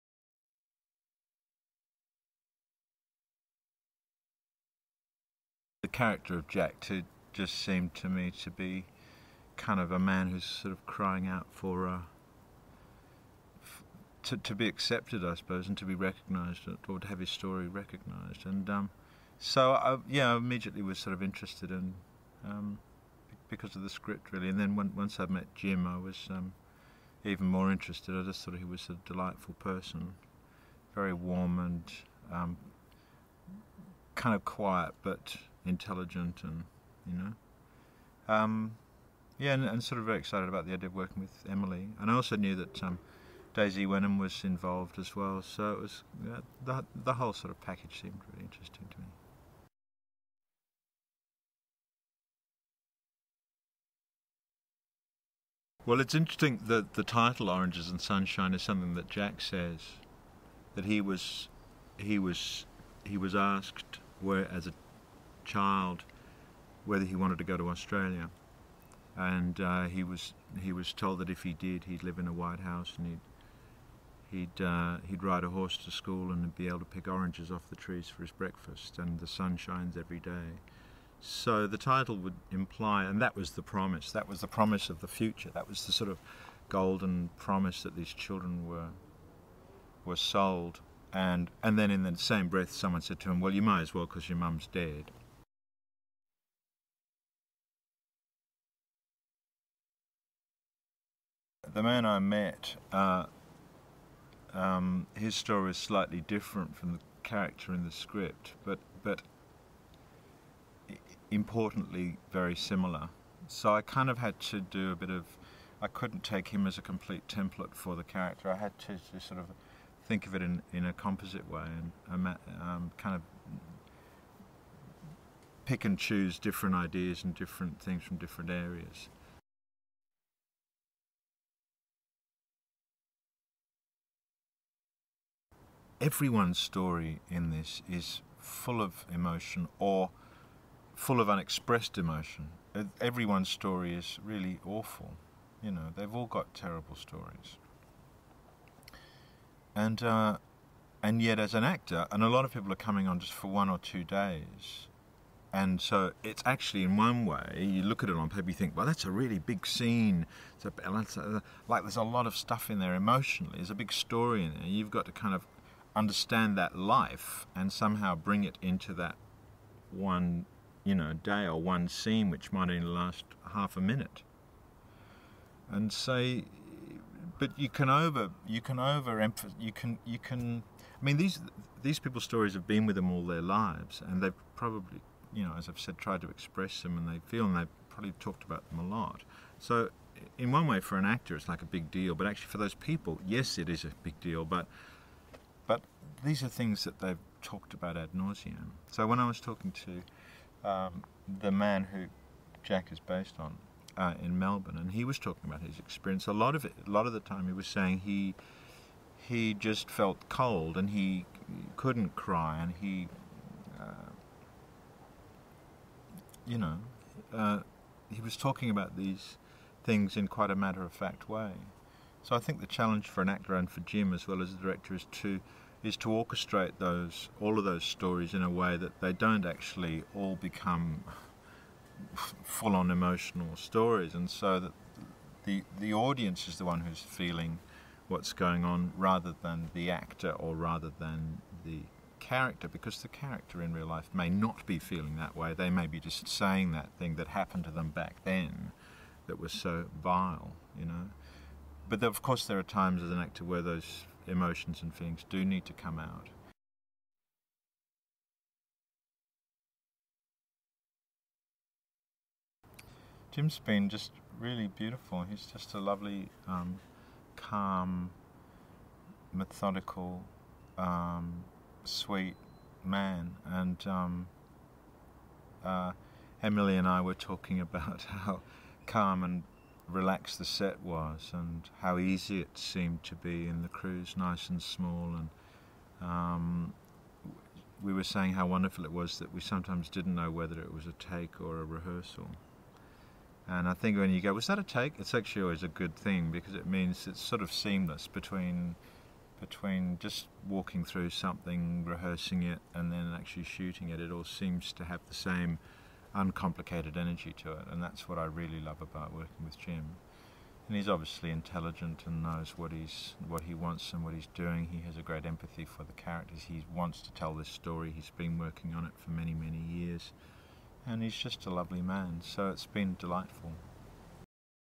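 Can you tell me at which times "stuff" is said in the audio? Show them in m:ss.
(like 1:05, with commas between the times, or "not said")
2:42.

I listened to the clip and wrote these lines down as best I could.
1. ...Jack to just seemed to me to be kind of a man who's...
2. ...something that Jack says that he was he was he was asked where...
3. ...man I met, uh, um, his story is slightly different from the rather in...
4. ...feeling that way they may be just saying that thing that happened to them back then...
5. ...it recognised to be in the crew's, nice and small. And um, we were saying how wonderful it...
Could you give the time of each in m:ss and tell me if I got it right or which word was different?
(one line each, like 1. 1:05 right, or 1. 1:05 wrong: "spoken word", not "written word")
1. 0:06 right
2. 0:58 right
3. 1:41 wrong: "character", not "rather"
4. 4:04 right
5. 4:42 wrong: "seemed", not "recognised".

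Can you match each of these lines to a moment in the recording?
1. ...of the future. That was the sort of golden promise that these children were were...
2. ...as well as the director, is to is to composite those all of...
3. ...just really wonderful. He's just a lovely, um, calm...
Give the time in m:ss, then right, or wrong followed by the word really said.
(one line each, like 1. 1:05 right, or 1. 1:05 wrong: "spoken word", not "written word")
1. 1:24 right
2. 3:44 wrong: "orchestrate", not "composite"
3. 4:23 wrong: "beautiful", not "wonderful".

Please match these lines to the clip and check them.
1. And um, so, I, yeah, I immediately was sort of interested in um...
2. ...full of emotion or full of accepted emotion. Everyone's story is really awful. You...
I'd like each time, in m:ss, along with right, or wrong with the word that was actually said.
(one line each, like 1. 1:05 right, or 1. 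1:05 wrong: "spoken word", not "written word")
1. 0:18 right
2. 2:18 wrong: "unexpressed", not "accepted".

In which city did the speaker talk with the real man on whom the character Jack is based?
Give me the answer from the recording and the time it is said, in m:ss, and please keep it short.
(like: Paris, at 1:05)
Melbourne, at 3:24.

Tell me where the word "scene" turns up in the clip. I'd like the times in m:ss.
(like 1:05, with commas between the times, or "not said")
2:39, 2:51.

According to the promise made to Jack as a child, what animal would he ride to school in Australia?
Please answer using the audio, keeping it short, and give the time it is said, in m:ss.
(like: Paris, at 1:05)
horse, at 1:15.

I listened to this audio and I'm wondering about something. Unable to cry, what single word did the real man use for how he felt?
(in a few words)
cold.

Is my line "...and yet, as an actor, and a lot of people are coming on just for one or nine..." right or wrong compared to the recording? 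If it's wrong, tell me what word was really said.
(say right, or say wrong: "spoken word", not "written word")
wrong: "two", not "nine".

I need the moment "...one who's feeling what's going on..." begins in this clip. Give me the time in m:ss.
3:56.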